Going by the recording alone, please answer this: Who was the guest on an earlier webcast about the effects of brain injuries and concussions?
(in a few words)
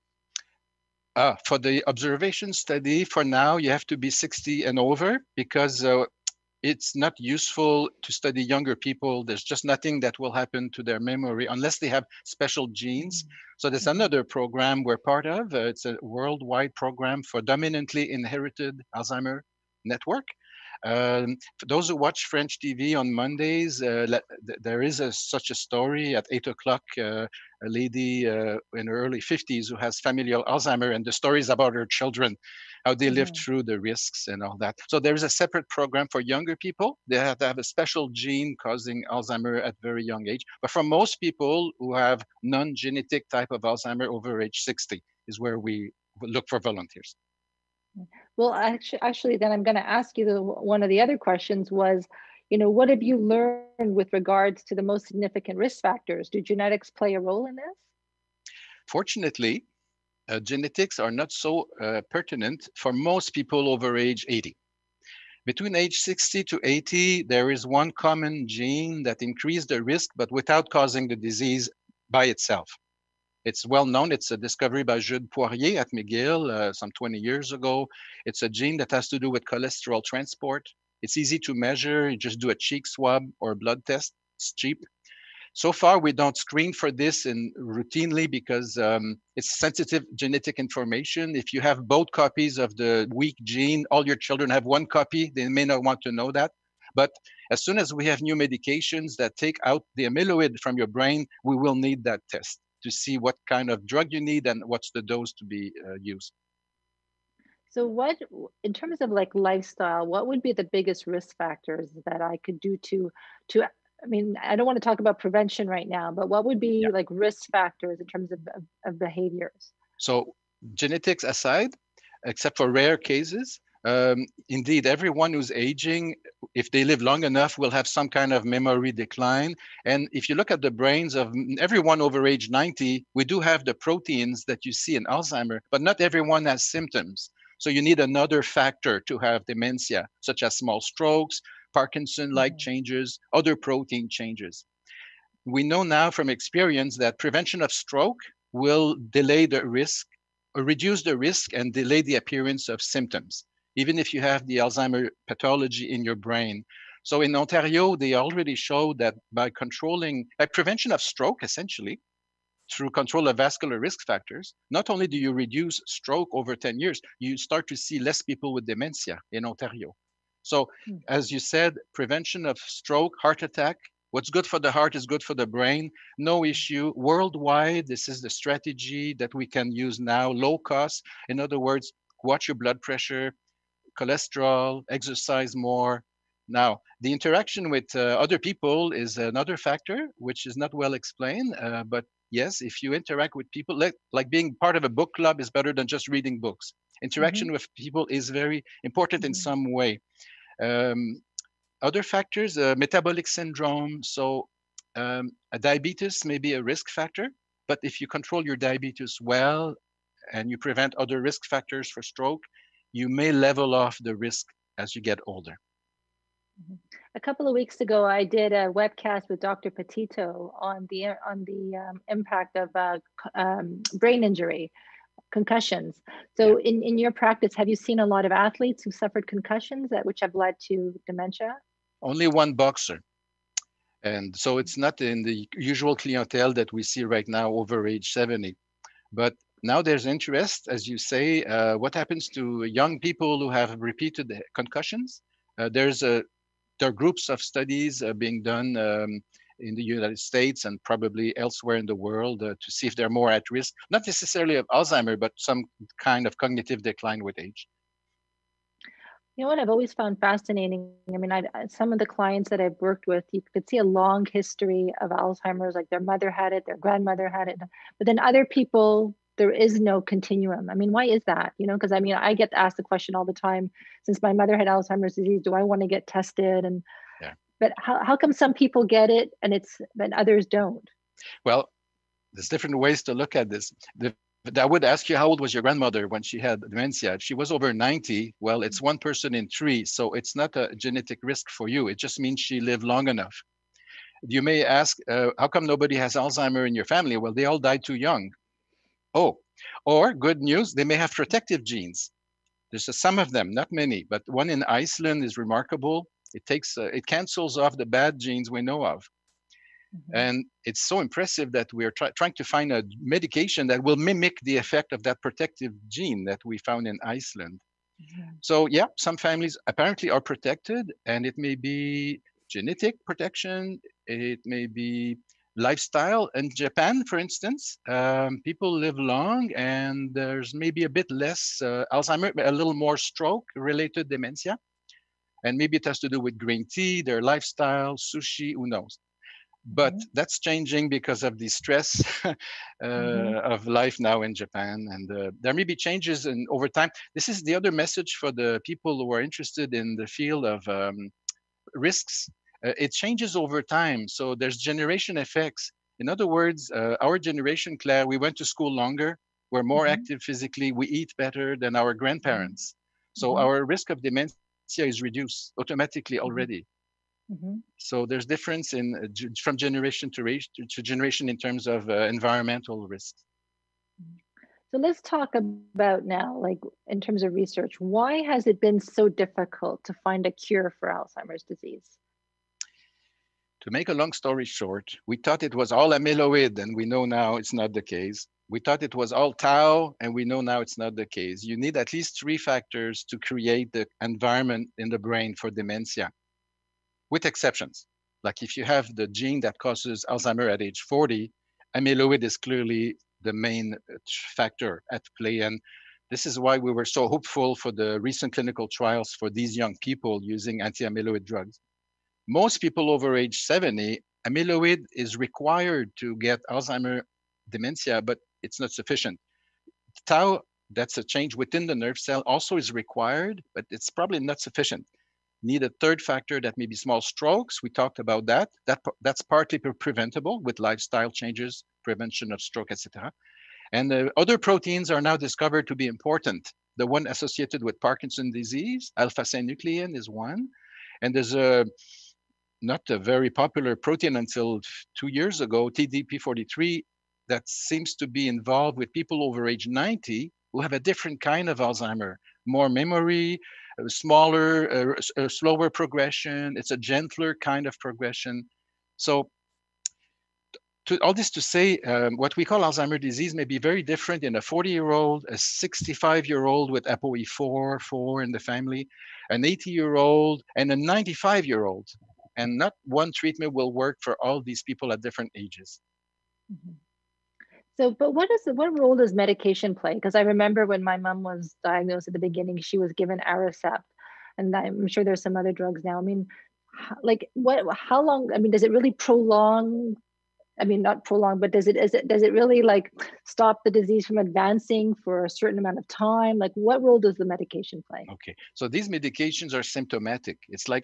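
Dr. Ptito.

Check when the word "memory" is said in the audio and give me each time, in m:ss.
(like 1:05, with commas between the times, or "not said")
0:10, 2:08, 7:32.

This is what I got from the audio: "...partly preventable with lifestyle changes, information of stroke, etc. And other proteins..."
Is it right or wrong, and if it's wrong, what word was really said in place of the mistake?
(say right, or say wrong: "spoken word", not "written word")
wrong: "prevention", not "information".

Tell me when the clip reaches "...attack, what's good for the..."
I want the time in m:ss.
2:53.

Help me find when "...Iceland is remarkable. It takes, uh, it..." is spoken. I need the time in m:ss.
5:04.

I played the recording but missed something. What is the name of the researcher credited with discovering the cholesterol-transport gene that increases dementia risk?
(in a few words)
Jude Poirier.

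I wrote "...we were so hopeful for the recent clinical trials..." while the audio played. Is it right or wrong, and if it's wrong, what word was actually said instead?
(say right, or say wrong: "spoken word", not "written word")
right.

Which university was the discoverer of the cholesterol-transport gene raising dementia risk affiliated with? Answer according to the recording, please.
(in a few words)
McGill.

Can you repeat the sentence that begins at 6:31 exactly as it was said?
You need at least three factors to create the environment in the brain for dementia, with exceptions.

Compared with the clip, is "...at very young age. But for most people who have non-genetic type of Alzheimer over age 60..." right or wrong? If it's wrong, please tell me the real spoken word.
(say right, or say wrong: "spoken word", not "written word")
right.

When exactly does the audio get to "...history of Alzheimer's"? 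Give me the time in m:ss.
4:24.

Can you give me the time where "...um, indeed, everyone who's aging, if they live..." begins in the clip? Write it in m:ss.
2:03.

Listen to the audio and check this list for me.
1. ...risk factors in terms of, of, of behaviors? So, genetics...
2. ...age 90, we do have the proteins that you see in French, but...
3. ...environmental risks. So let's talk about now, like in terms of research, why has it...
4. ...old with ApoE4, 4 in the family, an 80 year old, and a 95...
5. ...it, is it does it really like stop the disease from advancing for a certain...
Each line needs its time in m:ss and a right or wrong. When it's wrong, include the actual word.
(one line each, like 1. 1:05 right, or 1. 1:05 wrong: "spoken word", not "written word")
1. 1:57 right
2. 2:12 wrong: "Alzheimer", not "French"
3. 6:12 right
4. 7:46 right
5. 8:11 right.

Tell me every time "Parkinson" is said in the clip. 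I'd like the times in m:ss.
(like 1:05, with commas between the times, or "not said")
2:21, 7:17.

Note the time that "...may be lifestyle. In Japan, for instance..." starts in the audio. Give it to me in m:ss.
5:24.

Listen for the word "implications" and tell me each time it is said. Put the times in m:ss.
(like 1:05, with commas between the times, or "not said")
not said.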